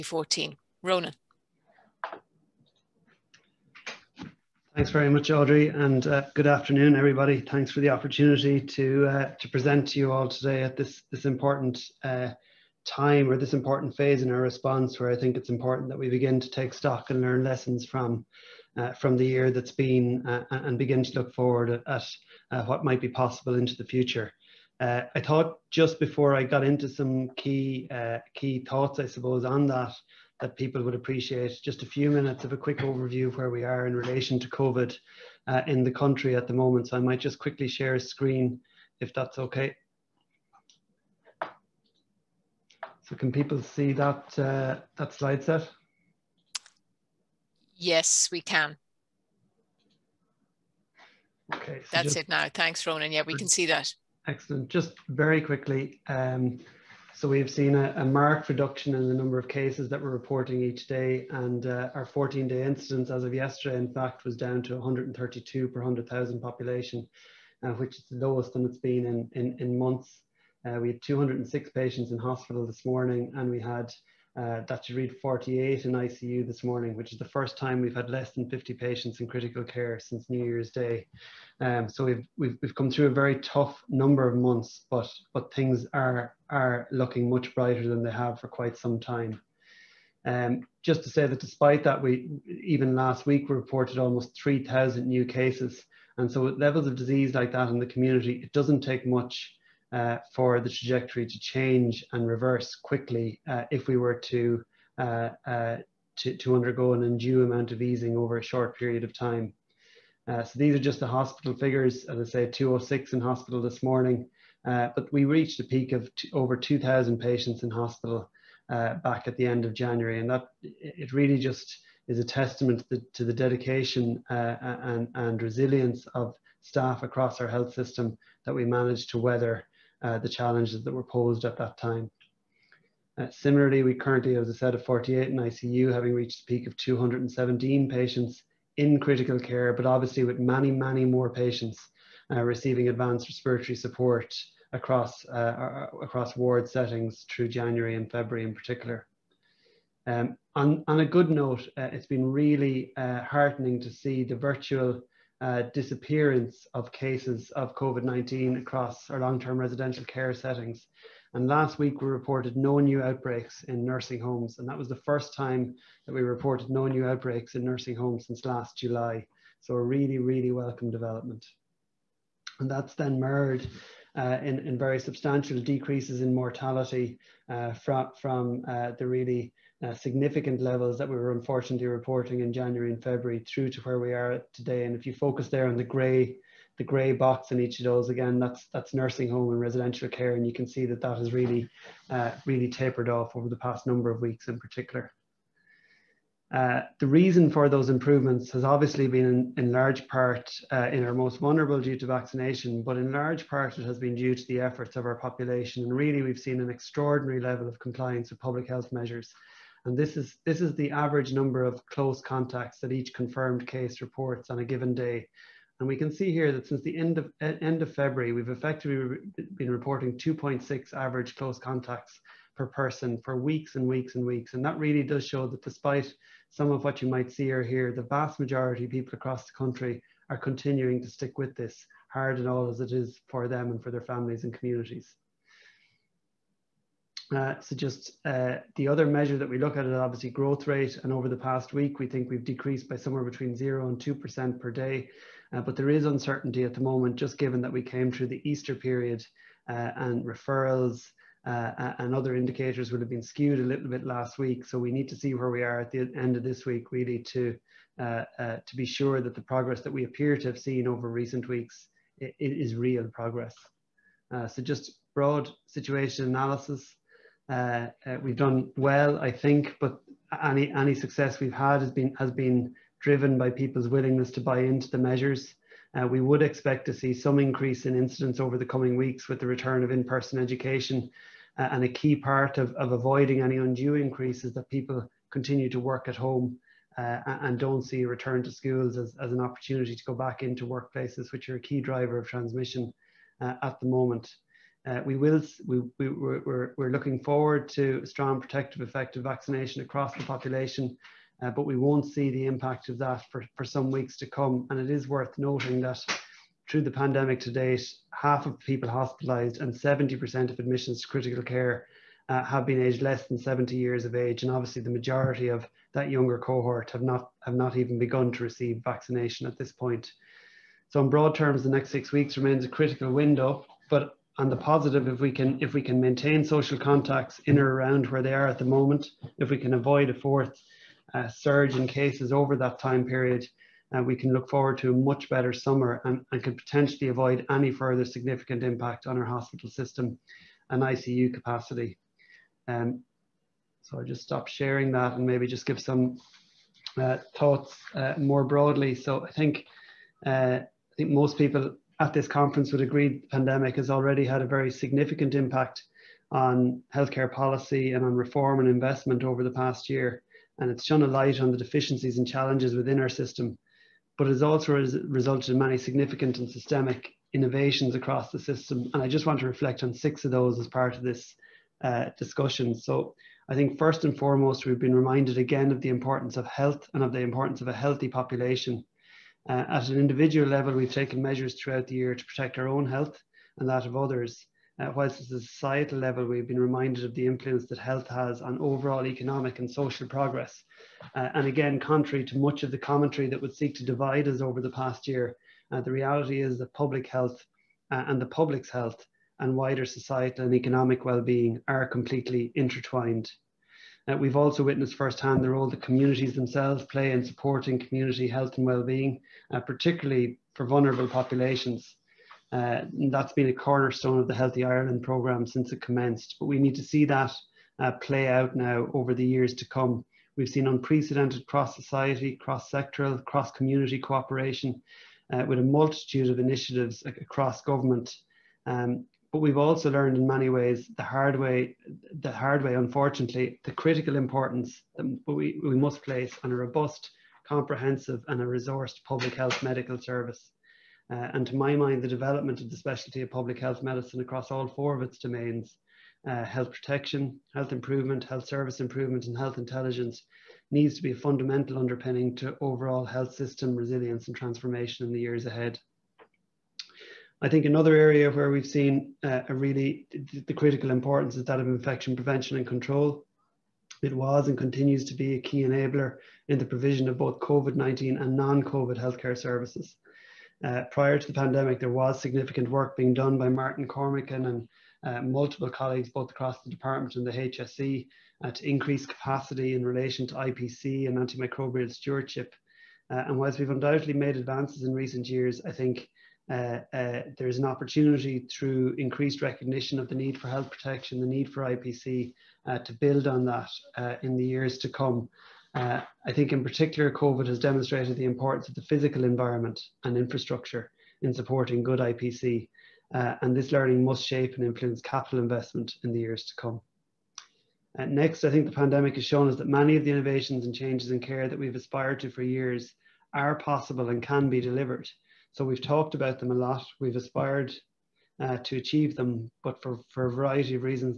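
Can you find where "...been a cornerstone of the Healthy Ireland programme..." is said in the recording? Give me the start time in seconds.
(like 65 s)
413 s.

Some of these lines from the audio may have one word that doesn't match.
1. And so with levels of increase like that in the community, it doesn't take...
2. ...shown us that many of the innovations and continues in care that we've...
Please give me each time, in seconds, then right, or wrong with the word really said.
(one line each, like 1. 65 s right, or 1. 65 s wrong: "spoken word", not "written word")
1. 96 s wrong: "disease", not "increase"
2. 509 s wrong: "changes", not "continues".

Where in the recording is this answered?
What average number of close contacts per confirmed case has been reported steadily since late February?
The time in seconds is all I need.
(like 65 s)
220 s.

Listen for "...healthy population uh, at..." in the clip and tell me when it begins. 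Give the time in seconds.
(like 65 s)
377 s.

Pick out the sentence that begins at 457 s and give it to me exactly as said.
I think another area where we've seen uh, a really the critical importance is that of infection prevention and control.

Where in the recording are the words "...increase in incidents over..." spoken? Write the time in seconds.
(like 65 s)
277 s.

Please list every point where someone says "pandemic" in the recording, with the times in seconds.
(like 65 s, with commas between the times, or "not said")
306 s, 353 s, 471 s, 508 s.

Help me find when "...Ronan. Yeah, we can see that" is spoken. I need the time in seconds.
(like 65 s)
52 s.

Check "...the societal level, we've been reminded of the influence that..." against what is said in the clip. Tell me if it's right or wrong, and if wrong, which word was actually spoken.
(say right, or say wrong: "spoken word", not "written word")
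right.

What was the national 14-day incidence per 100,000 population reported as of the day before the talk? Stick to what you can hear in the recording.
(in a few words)
132.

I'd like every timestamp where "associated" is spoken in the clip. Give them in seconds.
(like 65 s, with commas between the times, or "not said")
not said.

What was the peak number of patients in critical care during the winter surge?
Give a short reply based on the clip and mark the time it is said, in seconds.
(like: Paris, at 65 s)
217, at 136 s.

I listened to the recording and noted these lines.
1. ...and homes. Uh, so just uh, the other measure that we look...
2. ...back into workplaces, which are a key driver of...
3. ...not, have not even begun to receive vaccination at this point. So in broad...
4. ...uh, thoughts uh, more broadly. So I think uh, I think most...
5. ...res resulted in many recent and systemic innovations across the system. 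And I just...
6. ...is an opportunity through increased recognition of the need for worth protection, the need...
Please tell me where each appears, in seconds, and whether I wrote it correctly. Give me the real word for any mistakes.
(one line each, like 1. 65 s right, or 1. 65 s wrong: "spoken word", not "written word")
1. 234 s wrong: "communities", not "homes"
2. 290 s right
3. 317 s right
4. 347 s right
5. 364 s wrong: "significant", not "recent"
6. 487 s wrong: "health", not "worth".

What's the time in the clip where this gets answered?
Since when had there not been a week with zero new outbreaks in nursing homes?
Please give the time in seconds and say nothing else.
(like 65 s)
168 s.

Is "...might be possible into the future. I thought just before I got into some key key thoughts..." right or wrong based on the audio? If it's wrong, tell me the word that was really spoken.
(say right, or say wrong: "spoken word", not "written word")
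right.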